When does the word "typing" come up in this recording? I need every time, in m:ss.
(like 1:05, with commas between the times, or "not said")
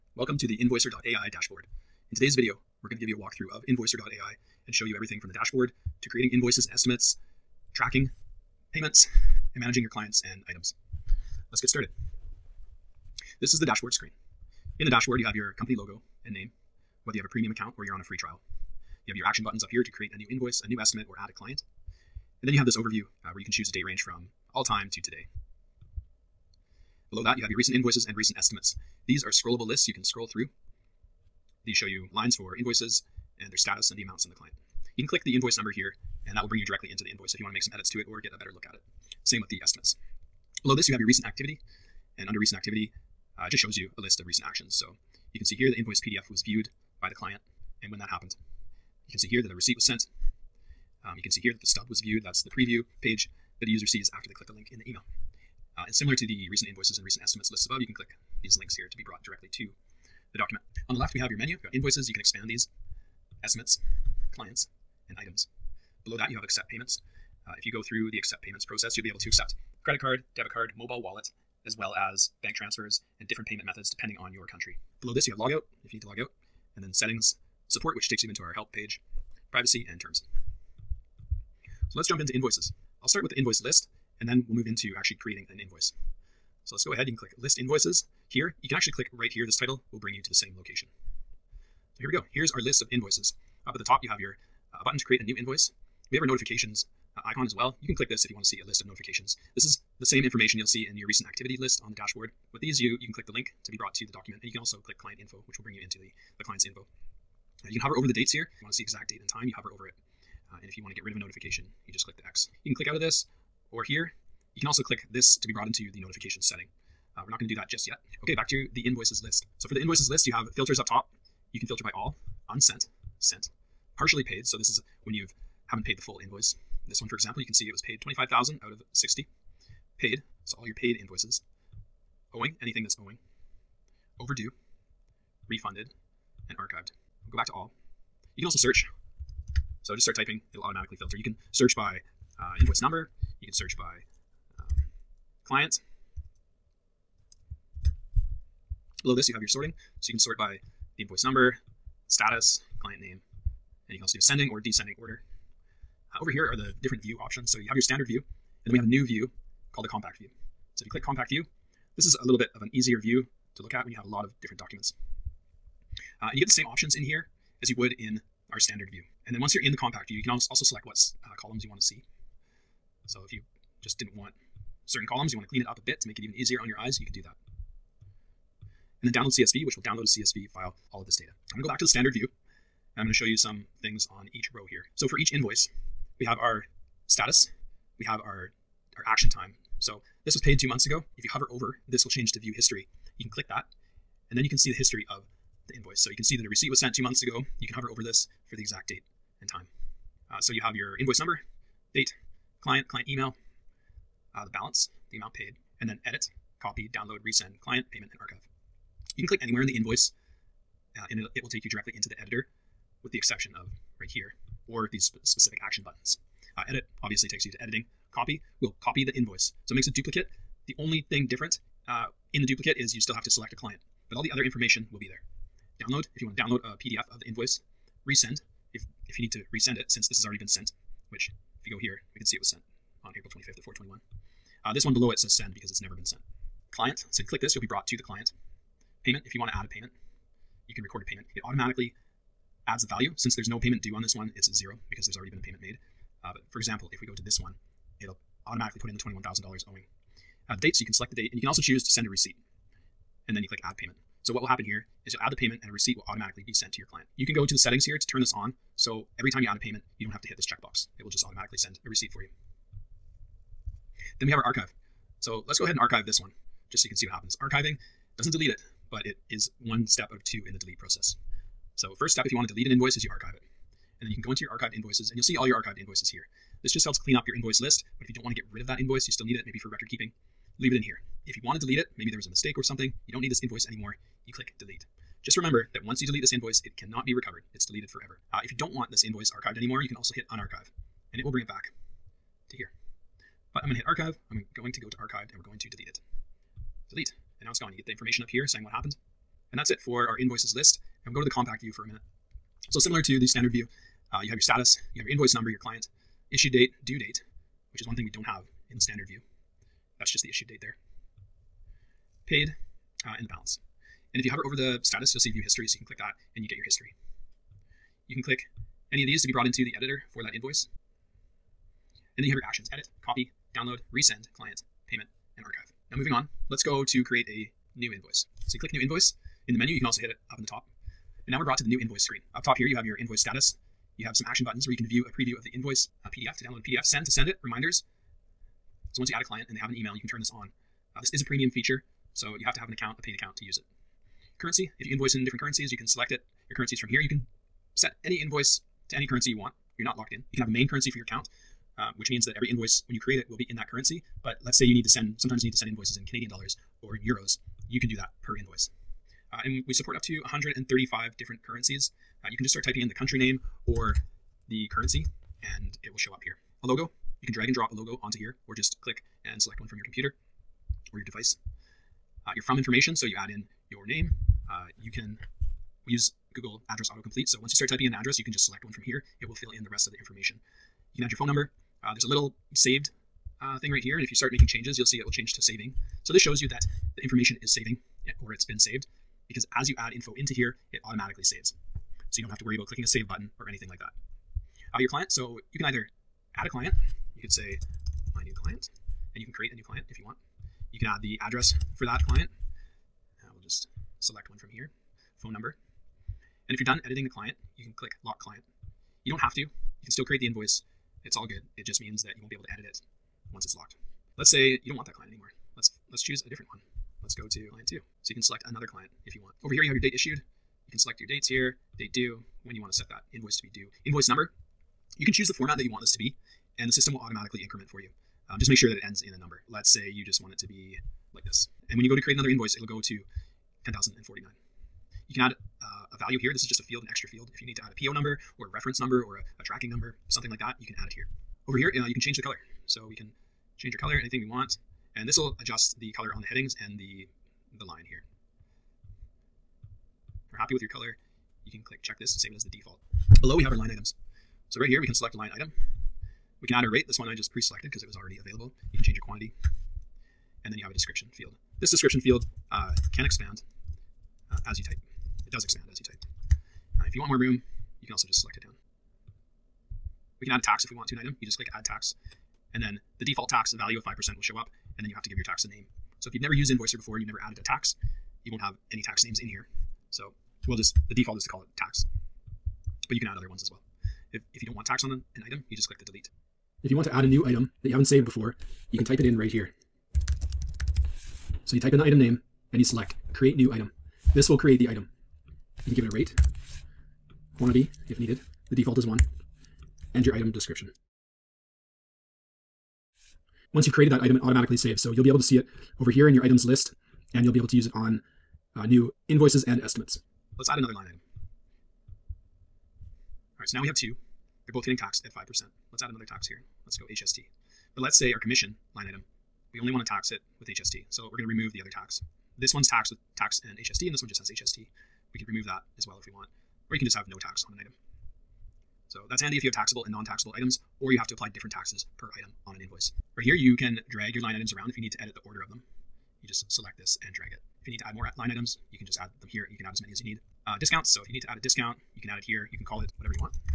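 2:20, 6:02, 6:17.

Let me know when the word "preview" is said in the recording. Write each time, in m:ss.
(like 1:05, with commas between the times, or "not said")
0:52, 5:35.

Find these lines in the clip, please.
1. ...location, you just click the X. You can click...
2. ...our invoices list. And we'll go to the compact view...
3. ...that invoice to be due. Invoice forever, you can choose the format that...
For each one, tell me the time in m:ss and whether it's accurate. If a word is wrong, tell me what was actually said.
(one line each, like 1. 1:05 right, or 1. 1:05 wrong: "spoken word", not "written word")
1. 1:51 wrong: "notification", not "location"
2. 5:00 right
3. 7:02 wrong: "number", not "forever".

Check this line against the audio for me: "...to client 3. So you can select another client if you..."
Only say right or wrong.
wrong.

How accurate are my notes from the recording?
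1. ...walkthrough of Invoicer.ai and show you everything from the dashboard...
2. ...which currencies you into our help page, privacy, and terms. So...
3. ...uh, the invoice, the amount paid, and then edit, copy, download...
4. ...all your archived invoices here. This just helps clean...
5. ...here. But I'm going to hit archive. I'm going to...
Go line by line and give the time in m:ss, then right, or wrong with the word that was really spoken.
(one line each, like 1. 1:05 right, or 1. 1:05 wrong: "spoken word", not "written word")
1. 0:03 right
2. 1:17 wrong: "takes", not "currencies"
3. 3:24 wrong: "balance", not "invoice"
4. 4:35 right
5. 4:52 right.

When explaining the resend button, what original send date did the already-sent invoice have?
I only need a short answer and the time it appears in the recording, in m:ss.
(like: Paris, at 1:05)
April 25th, at 3:53.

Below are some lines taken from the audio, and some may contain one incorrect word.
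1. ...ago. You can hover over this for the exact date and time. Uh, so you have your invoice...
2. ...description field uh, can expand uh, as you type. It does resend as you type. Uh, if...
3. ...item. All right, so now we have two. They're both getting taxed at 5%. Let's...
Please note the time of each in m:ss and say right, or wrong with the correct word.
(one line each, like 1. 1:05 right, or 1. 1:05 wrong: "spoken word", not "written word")
1. 3:17 right
2. 7:41 wrong: "expand", not "resend"
3. 8:30 right.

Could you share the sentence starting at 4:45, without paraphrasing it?
Just remember that once you delete this invoice, it cannot be recovered.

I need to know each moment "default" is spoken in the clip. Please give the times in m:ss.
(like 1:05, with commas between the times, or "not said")
7:32, 7:53, 8:00, 8:18.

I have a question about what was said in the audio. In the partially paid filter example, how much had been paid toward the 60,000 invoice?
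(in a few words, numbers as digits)
25,000.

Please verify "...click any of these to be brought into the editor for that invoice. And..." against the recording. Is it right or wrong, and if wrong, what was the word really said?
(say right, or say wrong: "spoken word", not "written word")
right.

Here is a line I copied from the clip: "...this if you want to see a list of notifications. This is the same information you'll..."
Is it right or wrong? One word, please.
right.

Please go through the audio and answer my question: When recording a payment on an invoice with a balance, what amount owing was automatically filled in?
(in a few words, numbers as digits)
$21,000.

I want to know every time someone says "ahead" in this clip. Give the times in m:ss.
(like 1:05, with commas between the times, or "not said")
1:26, 4:25.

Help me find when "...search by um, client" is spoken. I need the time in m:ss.
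2:23.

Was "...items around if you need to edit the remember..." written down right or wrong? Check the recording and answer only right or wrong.
wrong.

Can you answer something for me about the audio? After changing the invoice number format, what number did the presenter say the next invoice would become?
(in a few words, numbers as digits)
10,049.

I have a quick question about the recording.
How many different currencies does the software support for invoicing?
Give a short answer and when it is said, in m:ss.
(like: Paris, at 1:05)
135, at 6:00.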